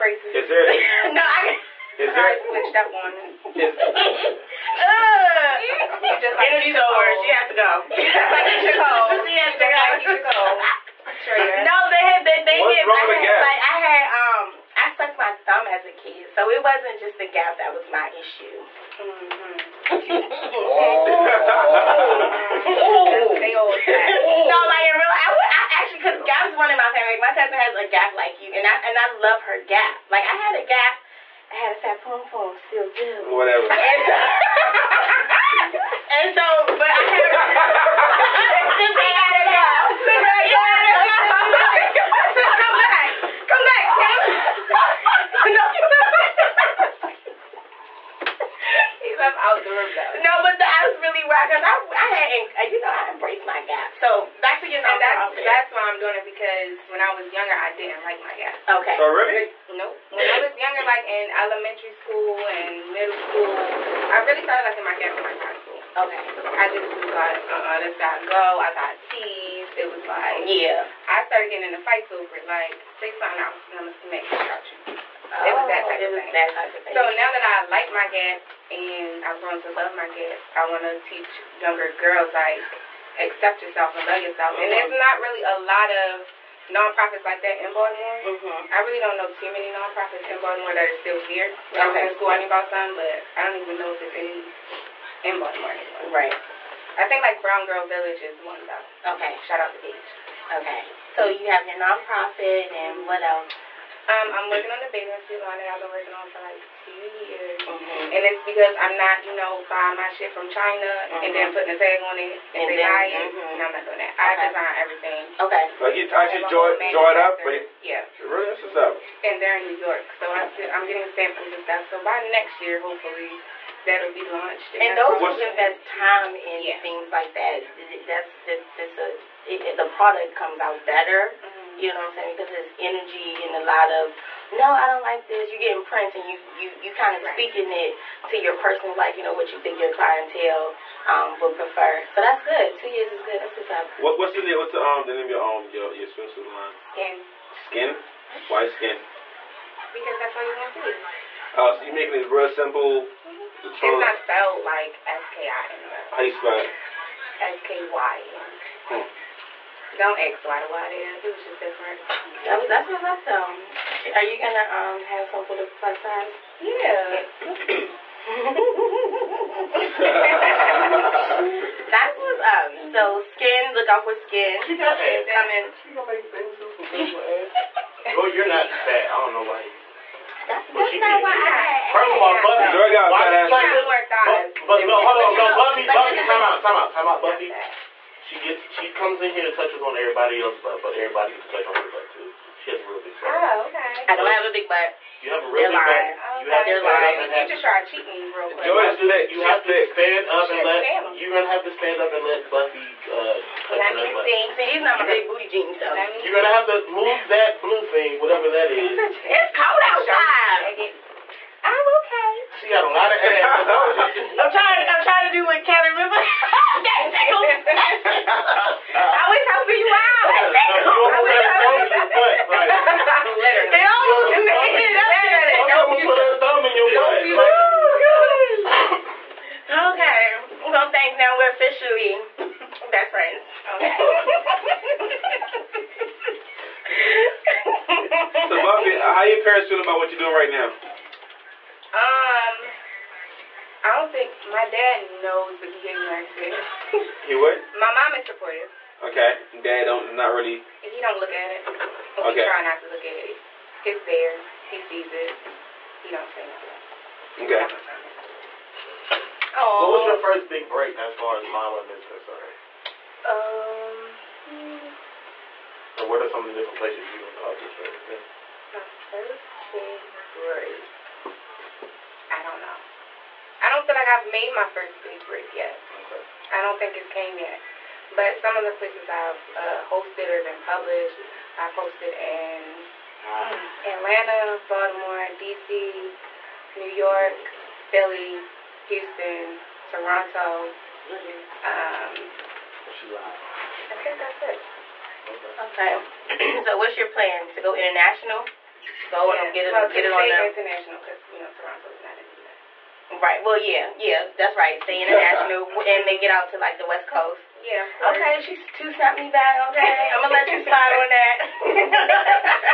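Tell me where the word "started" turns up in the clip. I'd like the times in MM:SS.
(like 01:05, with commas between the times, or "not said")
01:04, 01:11.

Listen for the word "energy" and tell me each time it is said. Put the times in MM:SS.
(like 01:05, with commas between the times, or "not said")
00:06, 02:12.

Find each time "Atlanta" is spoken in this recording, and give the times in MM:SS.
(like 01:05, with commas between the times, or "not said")
04:43.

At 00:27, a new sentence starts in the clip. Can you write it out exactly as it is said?
Like, my cousin has a gap like you, and I and I love her gap.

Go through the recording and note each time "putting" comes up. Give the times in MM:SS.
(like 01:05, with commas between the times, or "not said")
01:51.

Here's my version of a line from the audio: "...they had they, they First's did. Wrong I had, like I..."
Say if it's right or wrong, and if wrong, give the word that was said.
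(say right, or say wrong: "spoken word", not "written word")
wrong: "What", not "First".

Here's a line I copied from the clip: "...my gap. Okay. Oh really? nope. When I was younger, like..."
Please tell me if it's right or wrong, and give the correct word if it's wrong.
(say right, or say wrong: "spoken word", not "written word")
right.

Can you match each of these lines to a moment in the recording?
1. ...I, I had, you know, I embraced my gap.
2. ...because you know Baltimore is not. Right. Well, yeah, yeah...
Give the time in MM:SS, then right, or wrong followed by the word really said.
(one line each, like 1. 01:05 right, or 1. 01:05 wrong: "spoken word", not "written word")
1. 00:51 right
2. 05:01 wrong: "Toronto", not "Baltimore".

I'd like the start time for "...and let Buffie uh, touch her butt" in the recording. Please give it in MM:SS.
03:22.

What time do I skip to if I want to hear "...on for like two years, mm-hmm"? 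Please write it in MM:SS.
01:46.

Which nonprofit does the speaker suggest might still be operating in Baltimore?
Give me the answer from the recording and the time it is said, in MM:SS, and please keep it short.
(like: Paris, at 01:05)
Brown Girl Village, at 01:37.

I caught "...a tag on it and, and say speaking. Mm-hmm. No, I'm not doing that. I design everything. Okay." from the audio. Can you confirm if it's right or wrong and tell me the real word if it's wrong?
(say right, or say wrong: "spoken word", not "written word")
wrong: "lying", not "speaking".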